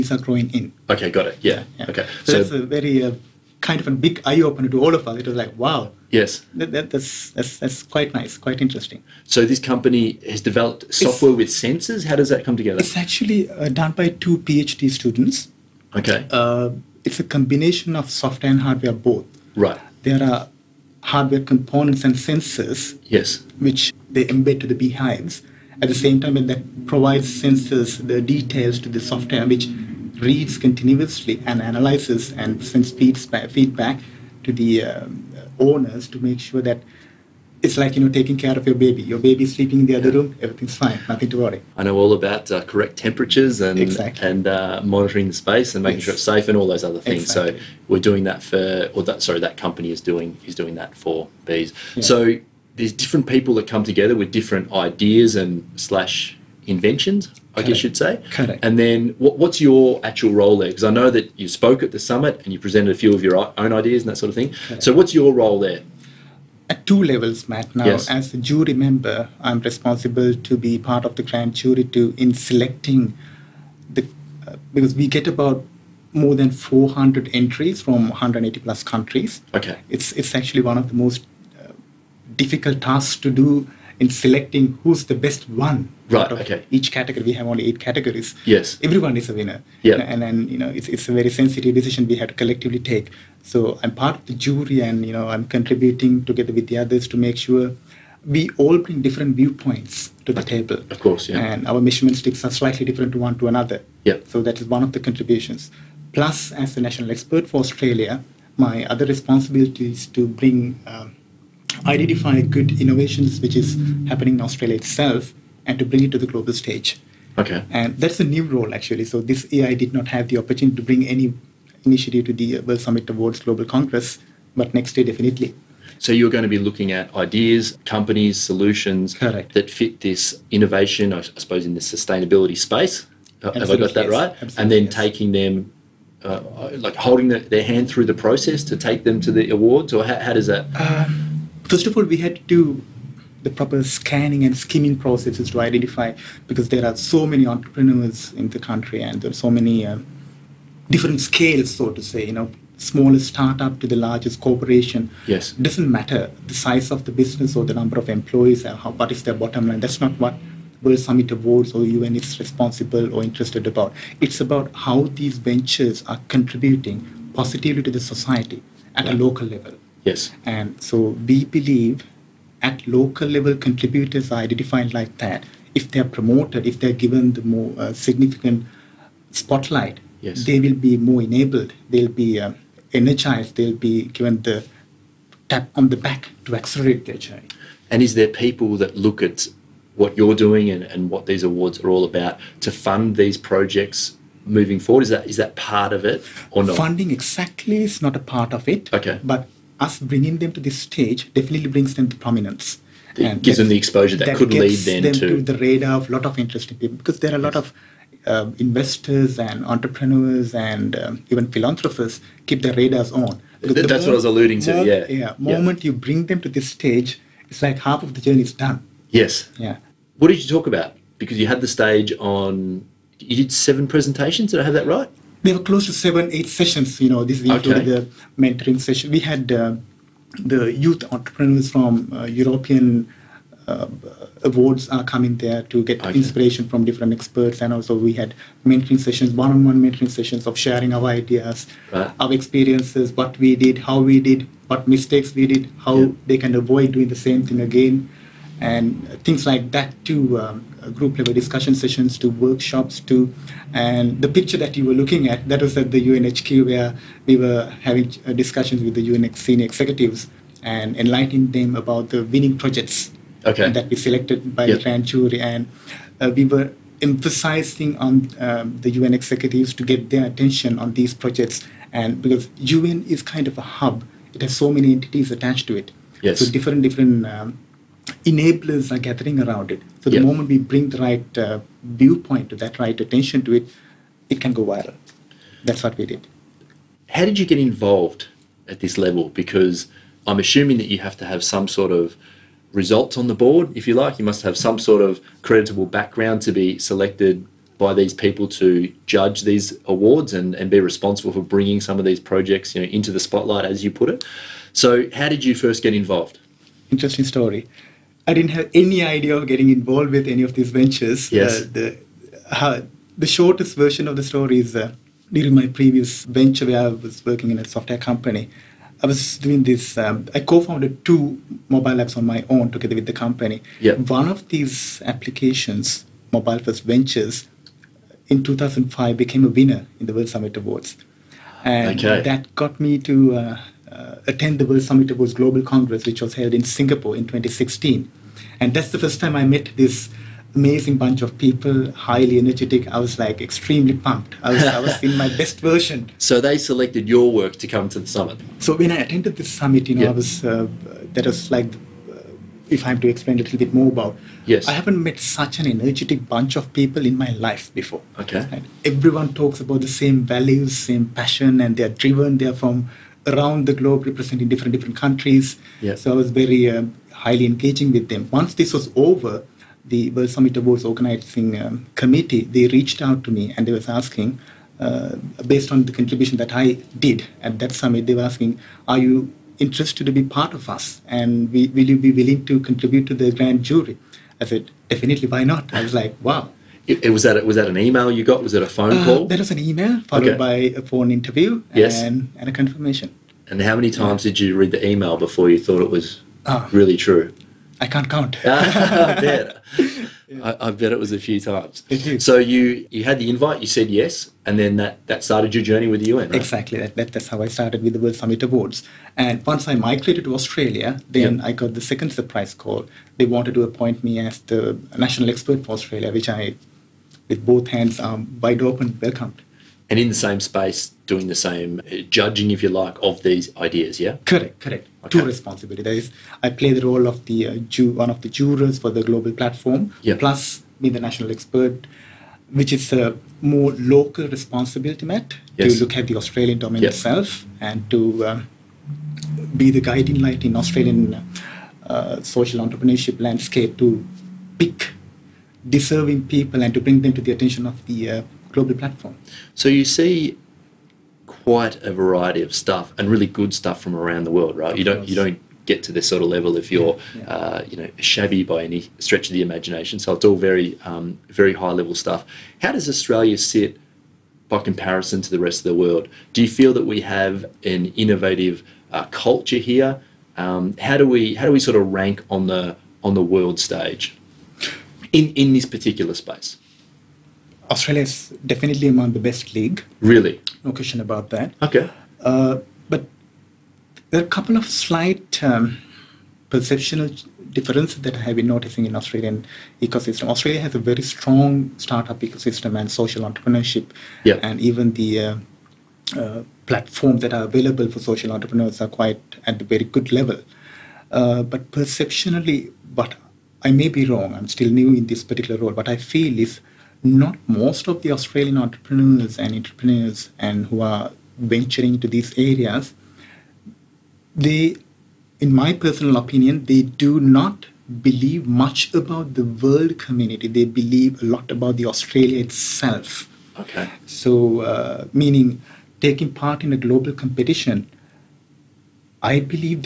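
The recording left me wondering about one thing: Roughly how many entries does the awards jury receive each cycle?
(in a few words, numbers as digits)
More than 400.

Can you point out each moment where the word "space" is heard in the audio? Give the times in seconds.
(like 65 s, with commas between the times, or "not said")
45 s, 132 s, 420 s, 476 s.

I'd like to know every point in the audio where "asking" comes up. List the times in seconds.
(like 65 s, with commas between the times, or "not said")
373 s, 378 s.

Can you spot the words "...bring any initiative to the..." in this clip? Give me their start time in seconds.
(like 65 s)
120 s.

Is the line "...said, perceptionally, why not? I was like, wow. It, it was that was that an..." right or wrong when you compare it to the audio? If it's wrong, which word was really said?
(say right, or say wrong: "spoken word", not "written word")
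wrong: "definitely", not "perceptionally".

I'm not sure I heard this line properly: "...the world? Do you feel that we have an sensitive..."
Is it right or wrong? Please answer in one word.
wrong.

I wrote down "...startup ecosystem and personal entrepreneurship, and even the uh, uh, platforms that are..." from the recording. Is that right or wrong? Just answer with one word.
wrong.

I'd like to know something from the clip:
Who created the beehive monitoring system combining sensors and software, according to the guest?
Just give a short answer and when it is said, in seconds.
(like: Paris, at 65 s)
Two PhD students, at 14 s.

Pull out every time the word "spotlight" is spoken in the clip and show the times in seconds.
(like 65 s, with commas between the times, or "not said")
179 s, 303 s.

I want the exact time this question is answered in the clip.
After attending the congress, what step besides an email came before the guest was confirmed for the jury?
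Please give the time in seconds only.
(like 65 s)
390 s.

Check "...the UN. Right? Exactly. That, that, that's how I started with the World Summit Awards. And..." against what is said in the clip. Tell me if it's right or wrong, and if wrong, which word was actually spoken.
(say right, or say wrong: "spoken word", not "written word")
right.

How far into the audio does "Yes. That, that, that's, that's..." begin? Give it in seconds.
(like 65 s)
6 s.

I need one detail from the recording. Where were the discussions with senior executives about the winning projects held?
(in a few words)
UNHQ.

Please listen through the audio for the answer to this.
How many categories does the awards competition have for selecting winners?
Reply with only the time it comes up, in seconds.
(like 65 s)
87 s.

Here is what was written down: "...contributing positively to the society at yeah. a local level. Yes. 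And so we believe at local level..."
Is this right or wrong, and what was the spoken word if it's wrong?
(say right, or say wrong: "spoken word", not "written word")
right.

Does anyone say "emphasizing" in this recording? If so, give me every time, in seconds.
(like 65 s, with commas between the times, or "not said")
267 s.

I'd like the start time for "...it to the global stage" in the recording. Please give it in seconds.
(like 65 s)
116 s.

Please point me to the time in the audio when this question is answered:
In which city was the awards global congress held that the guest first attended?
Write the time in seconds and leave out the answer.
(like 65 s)
336 s.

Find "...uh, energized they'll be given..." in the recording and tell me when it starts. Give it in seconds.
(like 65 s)
182 s.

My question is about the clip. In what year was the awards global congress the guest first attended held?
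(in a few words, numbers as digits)
2016.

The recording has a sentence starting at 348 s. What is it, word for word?
So when I attended this summit, you know, yep.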